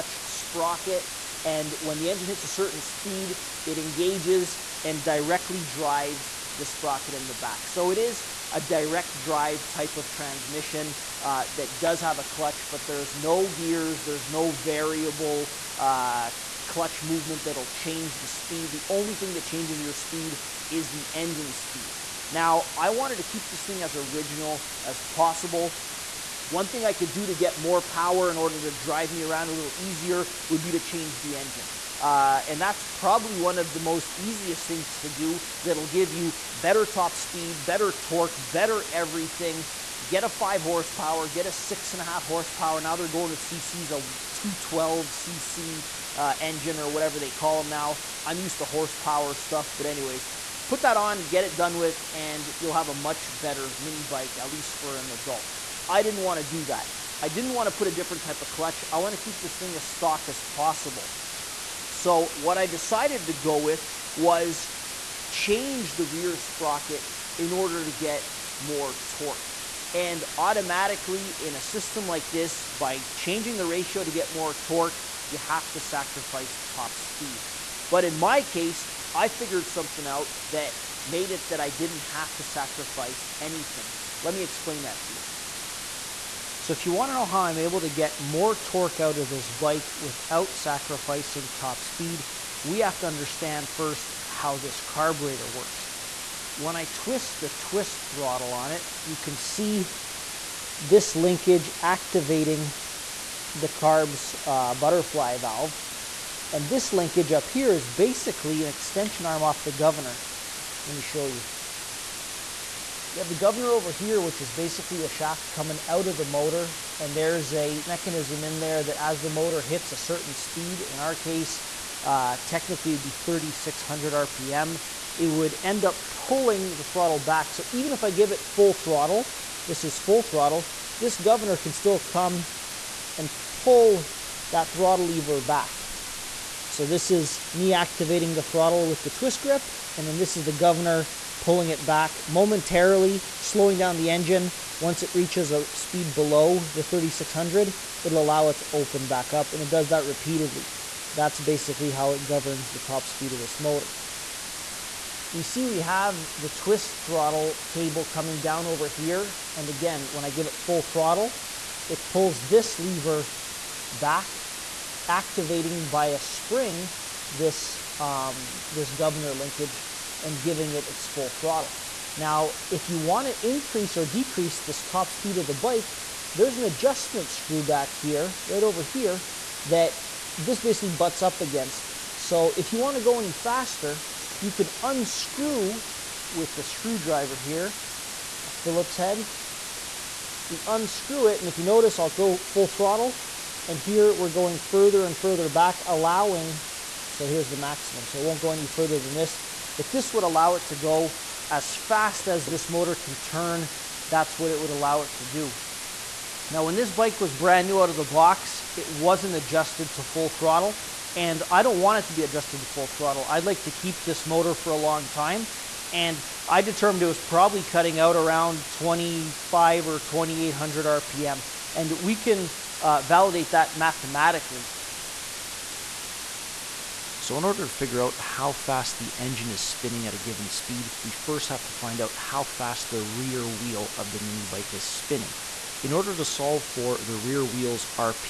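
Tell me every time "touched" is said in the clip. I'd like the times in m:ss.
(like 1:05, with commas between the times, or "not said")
not said.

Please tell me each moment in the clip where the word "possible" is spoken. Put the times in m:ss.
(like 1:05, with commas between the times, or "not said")
0:25, 1:00.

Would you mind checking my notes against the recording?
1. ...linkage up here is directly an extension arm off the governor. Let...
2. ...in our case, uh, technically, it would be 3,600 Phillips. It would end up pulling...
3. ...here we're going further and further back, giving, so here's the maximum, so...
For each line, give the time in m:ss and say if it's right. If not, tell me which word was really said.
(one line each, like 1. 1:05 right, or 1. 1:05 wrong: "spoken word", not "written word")
1. 1:46 wrong: "basically", not "directly"
2. 2:00 wrong: "RPM", not "Phillips"
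3. 3:13 wrong: "allowing", not "giving".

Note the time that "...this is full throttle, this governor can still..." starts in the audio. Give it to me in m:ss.
2:09.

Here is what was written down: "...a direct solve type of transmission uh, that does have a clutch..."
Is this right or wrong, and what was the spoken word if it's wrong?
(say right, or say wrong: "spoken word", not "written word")
wrong: "drive", not "solve".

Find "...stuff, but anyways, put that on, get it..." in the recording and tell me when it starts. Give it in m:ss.
0:49.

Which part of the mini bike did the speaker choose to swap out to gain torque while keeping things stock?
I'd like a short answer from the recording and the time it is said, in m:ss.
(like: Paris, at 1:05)
rear sprocket, at 1:06.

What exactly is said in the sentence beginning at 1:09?
And automatically in a system like this, by changing the ratio to get more torque, you have to sacrifice top speed.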